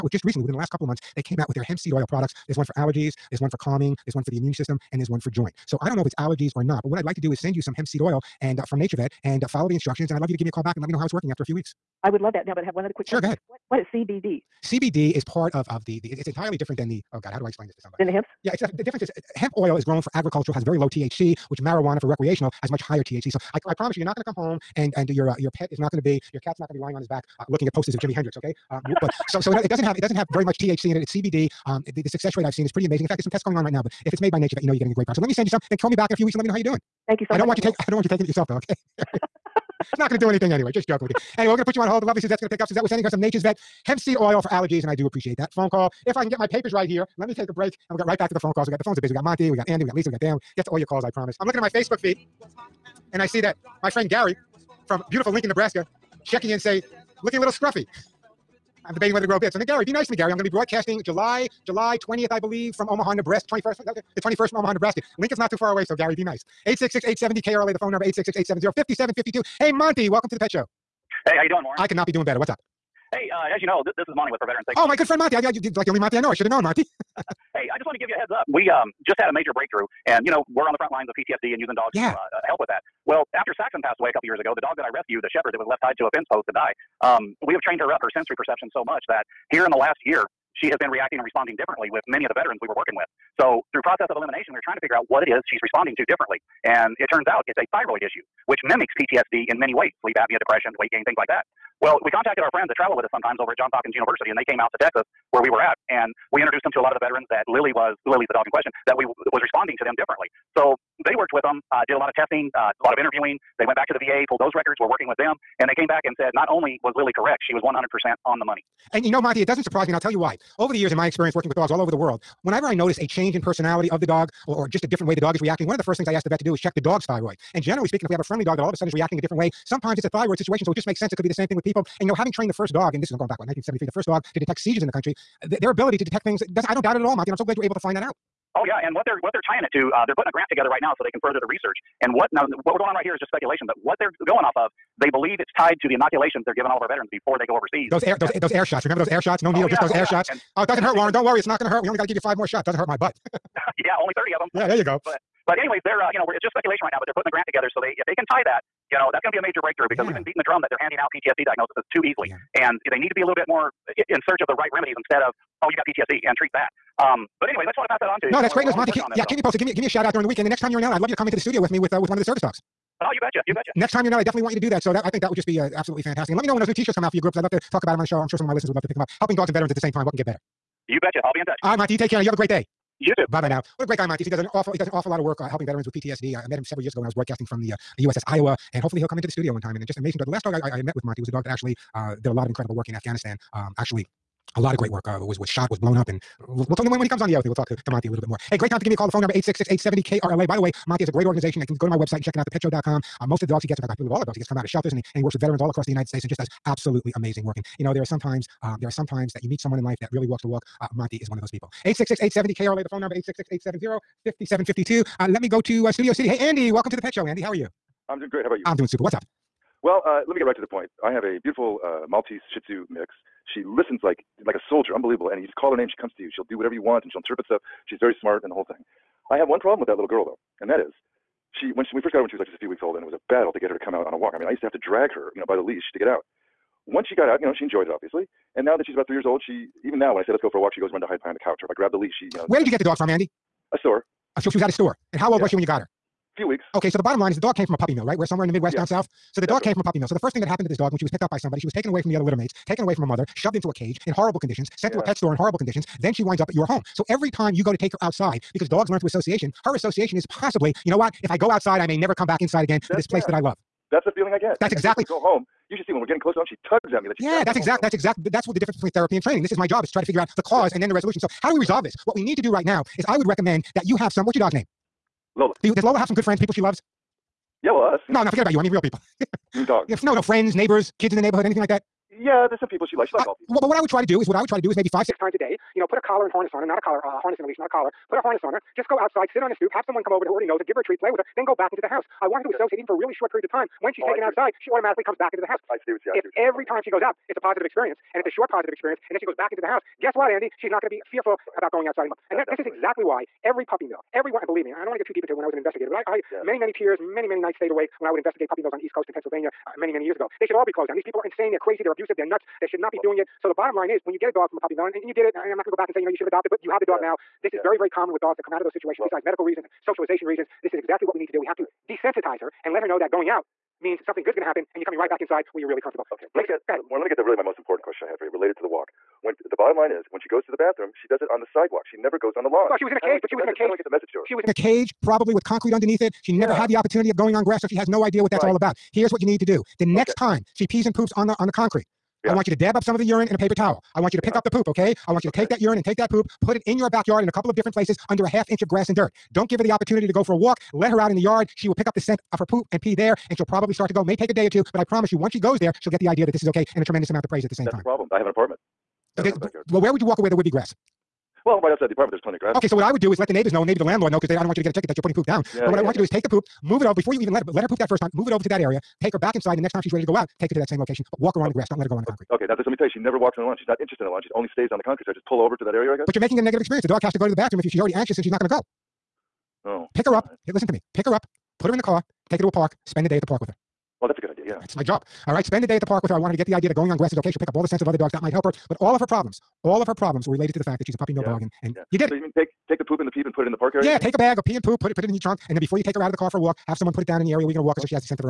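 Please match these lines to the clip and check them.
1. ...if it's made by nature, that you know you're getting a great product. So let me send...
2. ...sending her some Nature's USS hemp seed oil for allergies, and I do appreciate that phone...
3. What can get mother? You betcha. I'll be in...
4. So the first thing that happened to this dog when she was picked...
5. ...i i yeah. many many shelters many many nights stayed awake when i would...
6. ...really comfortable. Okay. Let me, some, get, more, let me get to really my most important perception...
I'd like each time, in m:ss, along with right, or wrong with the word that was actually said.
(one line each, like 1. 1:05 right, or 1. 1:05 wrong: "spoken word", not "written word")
1. 0:34 right
2. 0:42 wrong: "Vet", not "USS"
3. 3:00 wrong: "better", not "mother"
4. 4:10 right
5. 5:05 wrong: "tears", not "shelters"
6. 5:25 wrong: "question", not "perception".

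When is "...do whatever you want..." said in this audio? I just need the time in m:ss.
3:46.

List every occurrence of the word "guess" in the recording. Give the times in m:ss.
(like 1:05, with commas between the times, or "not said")
5:00, 6:15.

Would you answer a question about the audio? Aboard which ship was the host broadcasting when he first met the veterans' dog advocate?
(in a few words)
USS Iowa.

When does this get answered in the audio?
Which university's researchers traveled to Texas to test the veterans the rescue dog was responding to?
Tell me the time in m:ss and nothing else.
1:43.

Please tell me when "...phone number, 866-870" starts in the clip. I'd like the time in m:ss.
3:32.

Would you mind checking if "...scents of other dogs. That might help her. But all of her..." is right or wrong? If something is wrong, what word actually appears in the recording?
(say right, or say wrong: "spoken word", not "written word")
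right.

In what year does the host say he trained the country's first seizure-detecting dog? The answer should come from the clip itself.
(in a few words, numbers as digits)
1973.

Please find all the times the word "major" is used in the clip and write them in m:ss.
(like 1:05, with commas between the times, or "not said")
1:19, 2:39.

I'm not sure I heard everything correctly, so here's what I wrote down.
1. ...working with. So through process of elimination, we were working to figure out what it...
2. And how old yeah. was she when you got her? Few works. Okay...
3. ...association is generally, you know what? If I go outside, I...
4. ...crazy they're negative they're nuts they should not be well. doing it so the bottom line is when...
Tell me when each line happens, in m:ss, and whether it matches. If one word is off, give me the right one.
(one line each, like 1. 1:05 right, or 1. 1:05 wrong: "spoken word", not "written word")
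1. 1:32 wrong: "trying", not "working"
2. 4:05 wrong: "weeks", not "works"
3. 4:19 wrong: "possibly", not "generally"
4. 5:11 wrong: "abusive", not "negative".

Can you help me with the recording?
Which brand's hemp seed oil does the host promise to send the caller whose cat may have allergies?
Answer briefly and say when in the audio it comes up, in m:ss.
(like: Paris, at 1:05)
NaturVet, at 0:08.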